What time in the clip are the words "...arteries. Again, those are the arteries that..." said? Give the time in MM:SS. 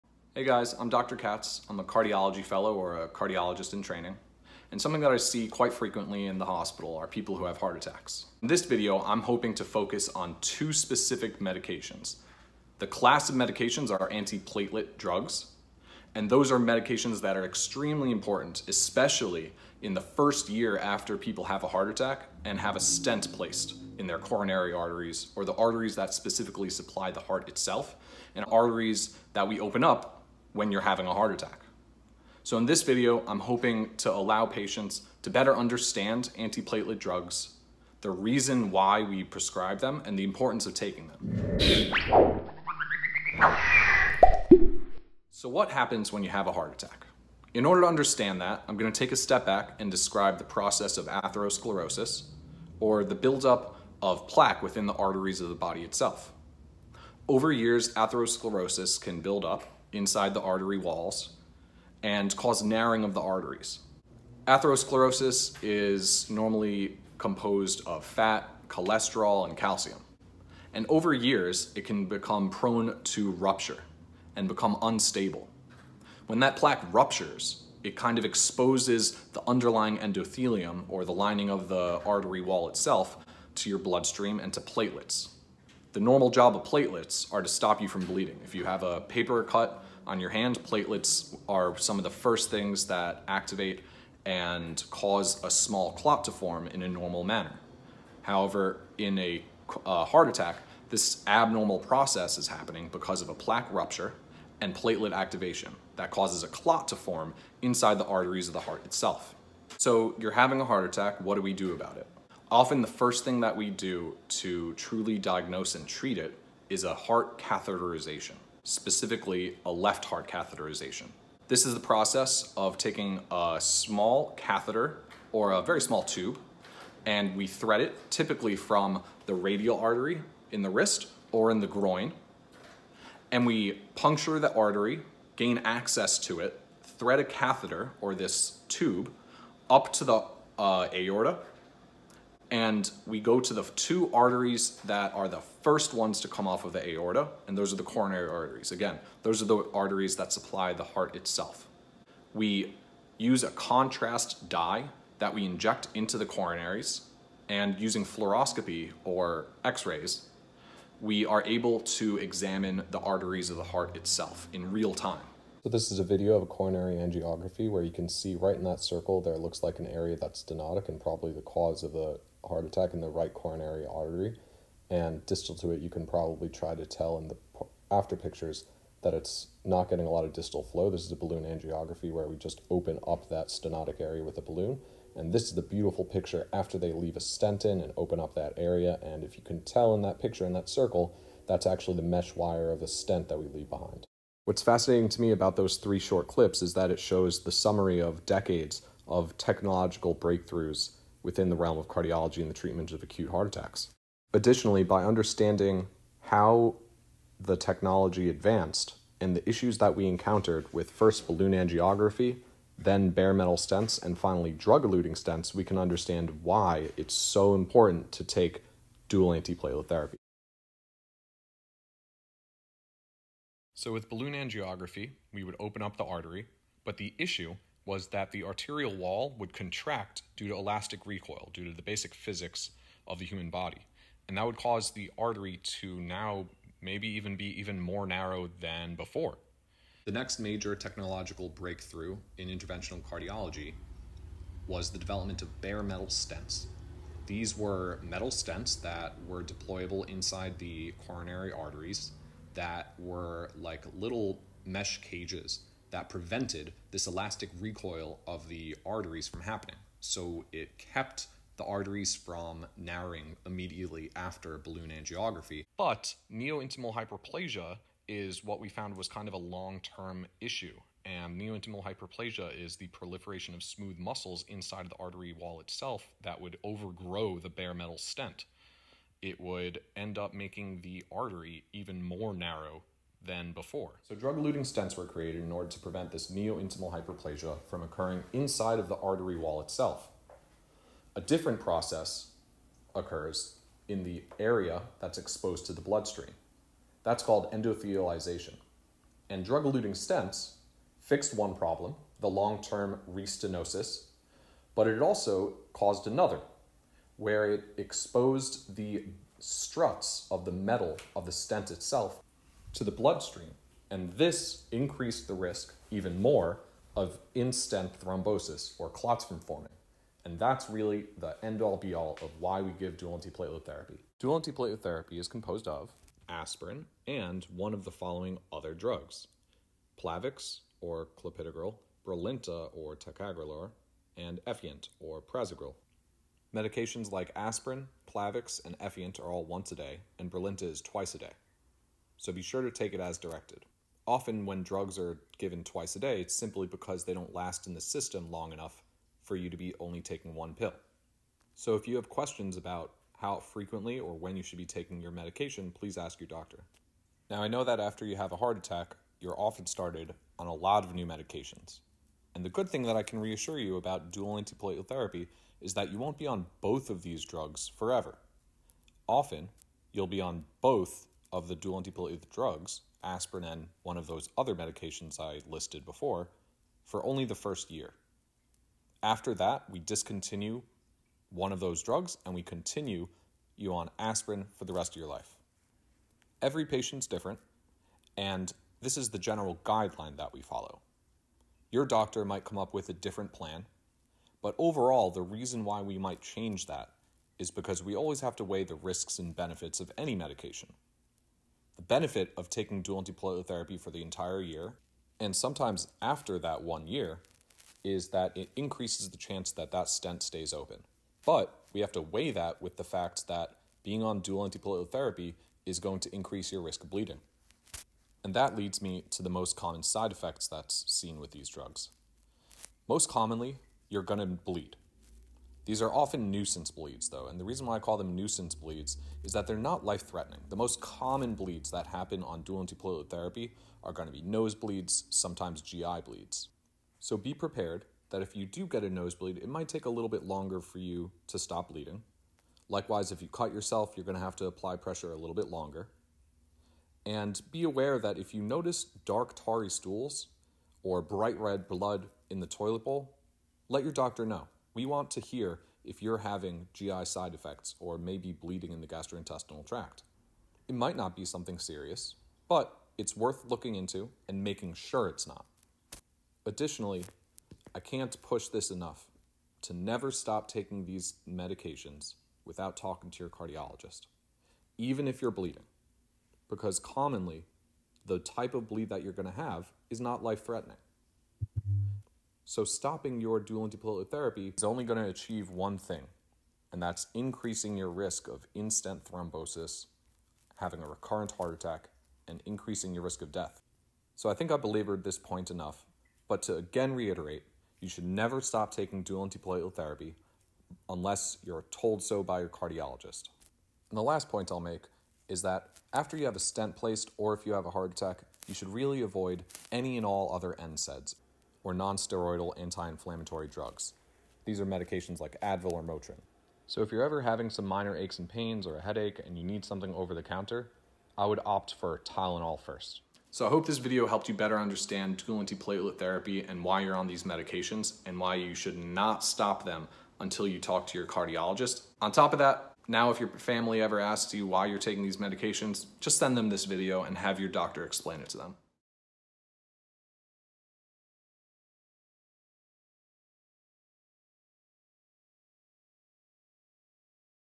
02:28.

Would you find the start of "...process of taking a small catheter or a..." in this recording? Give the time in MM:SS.
02:01.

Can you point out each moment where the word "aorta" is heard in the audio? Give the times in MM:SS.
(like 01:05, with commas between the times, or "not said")
02:20, 02:26.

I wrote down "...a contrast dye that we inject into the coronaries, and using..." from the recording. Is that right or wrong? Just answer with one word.
right.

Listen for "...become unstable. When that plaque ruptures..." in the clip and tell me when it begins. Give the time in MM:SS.
01:14.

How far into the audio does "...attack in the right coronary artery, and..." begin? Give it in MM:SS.
02:52.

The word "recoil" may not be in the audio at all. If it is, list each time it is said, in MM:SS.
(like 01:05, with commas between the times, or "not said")
03:51, 04:17.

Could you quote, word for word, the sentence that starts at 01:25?
The normal job of platelets are to stop you from bleeding.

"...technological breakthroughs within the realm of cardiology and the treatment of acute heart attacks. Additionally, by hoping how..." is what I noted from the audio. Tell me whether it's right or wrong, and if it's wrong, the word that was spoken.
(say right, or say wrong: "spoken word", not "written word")
wrong: "understanding", not "hoping".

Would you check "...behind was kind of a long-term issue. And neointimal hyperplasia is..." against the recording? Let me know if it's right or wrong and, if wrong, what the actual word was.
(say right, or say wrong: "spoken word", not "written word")
wrong: "found", not "behind".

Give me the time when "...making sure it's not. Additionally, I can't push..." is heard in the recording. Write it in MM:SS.
07:44.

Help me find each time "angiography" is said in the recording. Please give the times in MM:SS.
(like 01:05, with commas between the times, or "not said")
02:46, 03:01, 03:31, 03:44, 04:24.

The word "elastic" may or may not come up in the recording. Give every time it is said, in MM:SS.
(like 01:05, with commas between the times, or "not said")
03:50, 04:17.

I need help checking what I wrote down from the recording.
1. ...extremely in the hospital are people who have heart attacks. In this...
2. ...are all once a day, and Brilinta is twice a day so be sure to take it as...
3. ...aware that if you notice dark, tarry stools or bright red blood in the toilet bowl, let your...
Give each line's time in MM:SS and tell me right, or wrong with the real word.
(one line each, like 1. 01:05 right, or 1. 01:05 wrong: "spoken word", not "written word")
1. 00:05 wrong: "frequently", not "extremely"
2. 05:39 right
3. 07:27 right.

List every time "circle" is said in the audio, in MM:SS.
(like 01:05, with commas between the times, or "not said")
02:48, 03:10.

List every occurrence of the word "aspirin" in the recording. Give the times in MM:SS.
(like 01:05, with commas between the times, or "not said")
05:26, 05:37, 06:13, 06:23.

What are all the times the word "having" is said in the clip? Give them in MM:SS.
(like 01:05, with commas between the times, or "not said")
00:30, 01:50, 07:36, 08:10, 08:37.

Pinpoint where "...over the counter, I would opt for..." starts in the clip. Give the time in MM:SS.
08:39.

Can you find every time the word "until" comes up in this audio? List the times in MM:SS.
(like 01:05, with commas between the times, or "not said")
08:50.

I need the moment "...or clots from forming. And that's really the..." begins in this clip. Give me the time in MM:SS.
05:18.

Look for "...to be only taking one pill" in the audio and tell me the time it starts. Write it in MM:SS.
05:49.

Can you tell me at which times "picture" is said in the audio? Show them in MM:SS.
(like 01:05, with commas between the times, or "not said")
02:58, 03:06, 03:10.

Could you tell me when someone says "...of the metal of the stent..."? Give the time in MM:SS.
05:10.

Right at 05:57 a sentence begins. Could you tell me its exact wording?
Now, I know that after you have a heart attack, you're often started on a lot of new medications.